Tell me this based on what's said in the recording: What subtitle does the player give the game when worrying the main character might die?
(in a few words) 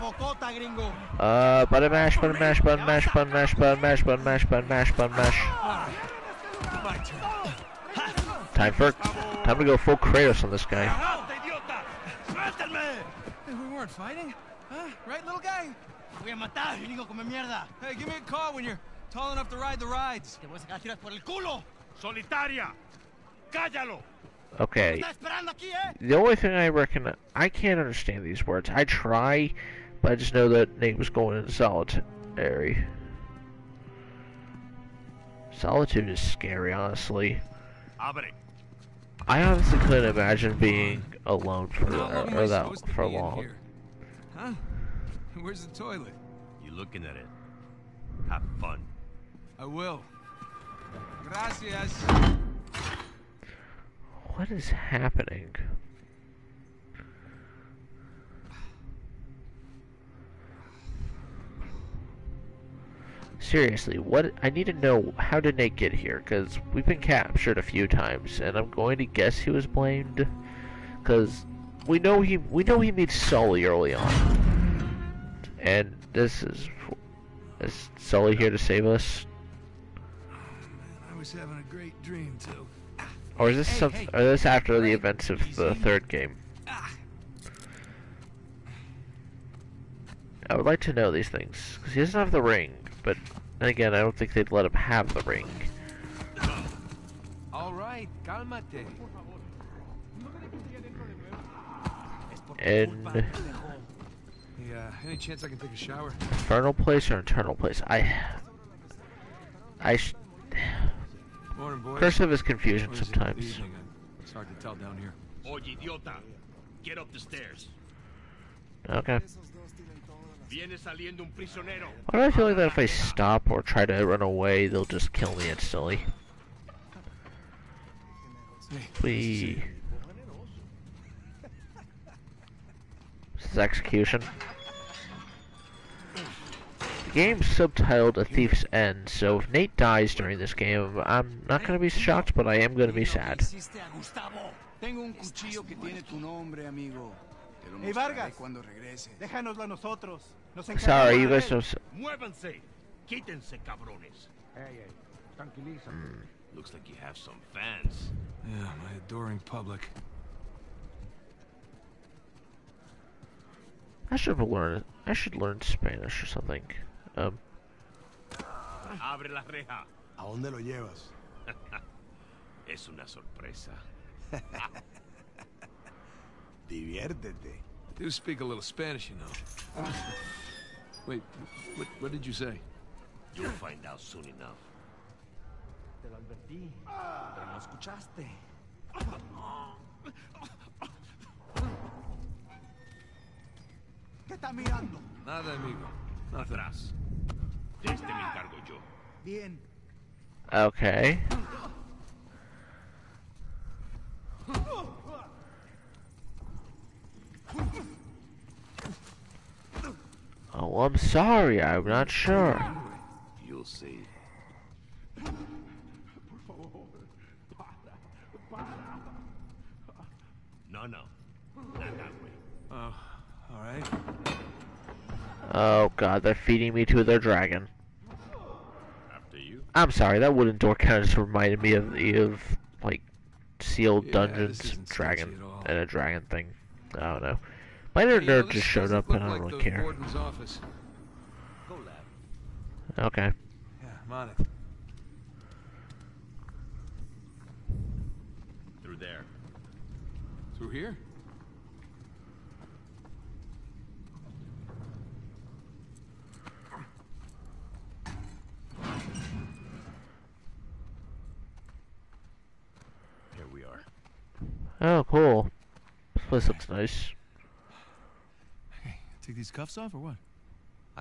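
A Thief's End.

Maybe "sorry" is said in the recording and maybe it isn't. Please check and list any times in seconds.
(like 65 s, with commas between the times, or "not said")
143 s, 210 s, 229 s.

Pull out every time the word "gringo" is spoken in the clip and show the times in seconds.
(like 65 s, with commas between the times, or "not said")
0 s, 16 s.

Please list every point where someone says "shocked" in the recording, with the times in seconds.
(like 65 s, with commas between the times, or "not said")
141 s.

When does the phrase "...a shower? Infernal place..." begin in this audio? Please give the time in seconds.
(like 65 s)
105 s.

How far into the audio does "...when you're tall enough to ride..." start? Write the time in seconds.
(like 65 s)
18 s.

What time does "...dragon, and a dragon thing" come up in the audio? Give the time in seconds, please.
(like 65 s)
234 s.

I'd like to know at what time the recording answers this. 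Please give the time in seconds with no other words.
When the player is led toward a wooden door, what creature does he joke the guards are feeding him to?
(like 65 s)
227 s.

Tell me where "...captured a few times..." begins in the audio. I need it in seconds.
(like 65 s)
66 s.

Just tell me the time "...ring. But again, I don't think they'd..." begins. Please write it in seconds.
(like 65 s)
92 s.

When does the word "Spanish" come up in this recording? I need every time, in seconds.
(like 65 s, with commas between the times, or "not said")
165 s, 178 s.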